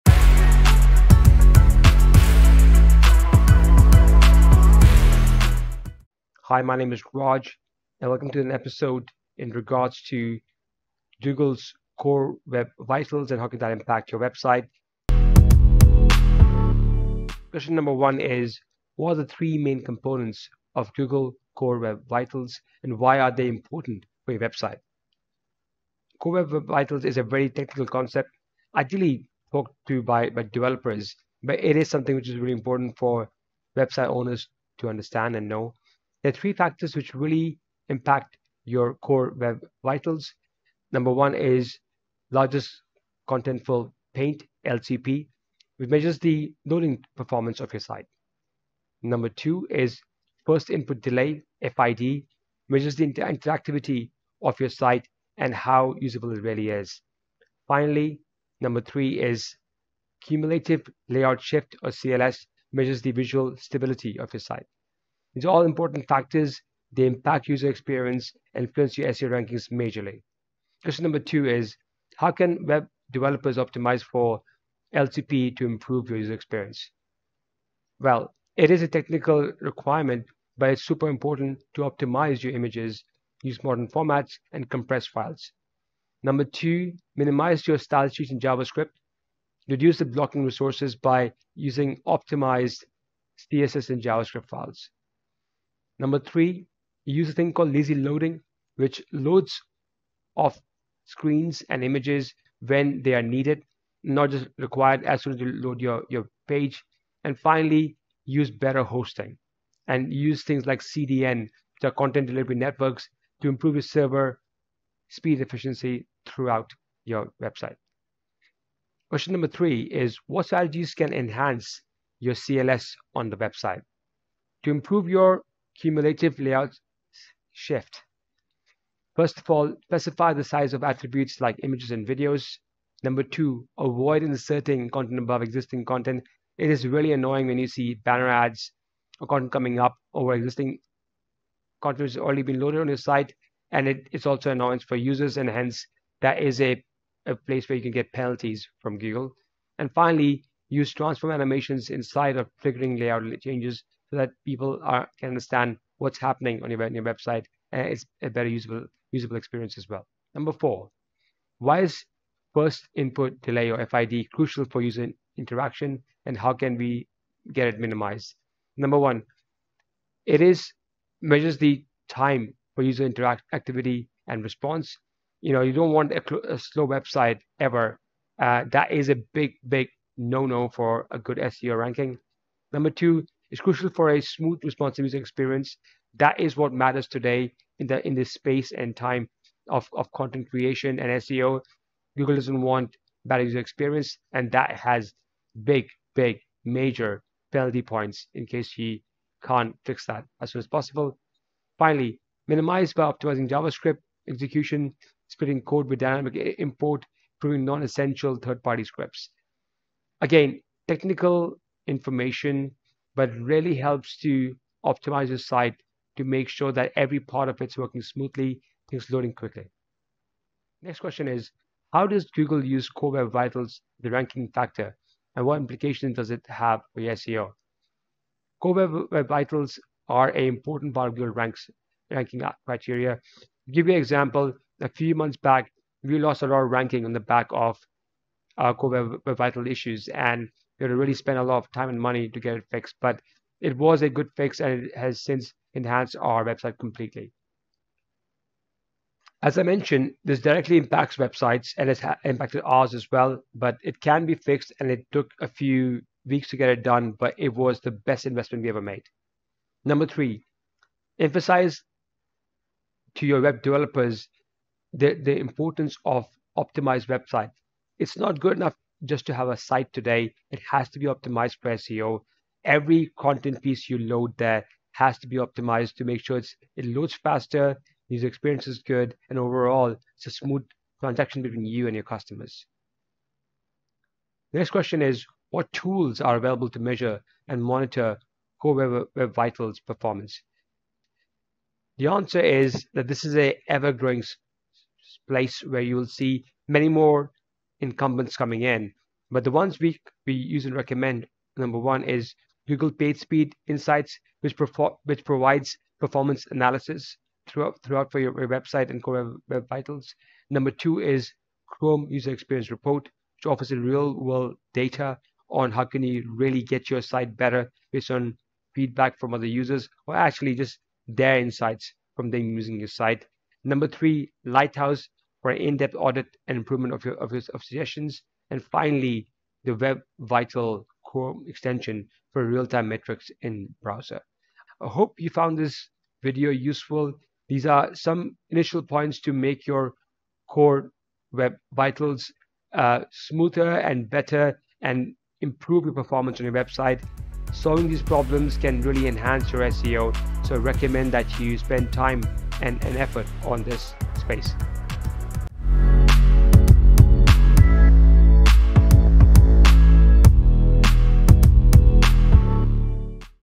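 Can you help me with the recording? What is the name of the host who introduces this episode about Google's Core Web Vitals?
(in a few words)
Raj.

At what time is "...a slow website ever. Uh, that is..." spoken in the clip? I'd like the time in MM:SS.
02:56.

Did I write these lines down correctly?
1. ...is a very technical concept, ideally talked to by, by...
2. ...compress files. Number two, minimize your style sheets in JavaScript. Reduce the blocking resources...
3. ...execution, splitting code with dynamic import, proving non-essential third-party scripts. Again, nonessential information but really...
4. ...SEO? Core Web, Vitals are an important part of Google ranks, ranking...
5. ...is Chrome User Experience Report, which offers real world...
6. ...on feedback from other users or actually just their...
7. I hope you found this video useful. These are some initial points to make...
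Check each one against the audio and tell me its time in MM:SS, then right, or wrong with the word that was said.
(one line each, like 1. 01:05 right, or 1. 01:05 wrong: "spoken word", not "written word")
1. 00:27 right
2. 01:24 right
3. 03:24 wrong: "technical", not "nonessential"
4. 03:47 right
5. 05:10 right
6. 05:18 right
7. 05:34 right.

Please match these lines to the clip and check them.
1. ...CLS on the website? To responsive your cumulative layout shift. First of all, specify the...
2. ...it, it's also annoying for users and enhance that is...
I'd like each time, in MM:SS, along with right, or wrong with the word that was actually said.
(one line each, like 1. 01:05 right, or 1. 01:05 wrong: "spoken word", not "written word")
1. 02:02 wrong: "improve", not "responsive"
2. 02:23 wrong: "hence", not "enhance".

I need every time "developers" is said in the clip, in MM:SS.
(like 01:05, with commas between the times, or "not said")
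00:30, 01:13, 04:23.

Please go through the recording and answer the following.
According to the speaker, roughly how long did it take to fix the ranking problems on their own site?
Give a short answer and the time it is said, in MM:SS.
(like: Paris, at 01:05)
A few weeks, at 04:15.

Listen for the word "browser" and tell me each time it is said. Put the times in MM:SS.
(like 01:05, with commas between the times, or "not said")
05:33.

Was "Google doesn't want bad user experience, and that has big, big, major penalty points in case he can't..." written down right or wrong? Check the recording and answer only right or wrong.
right.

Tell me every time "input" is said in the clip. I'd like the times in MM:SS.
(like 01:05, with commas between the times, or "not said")
00:50, 02:42.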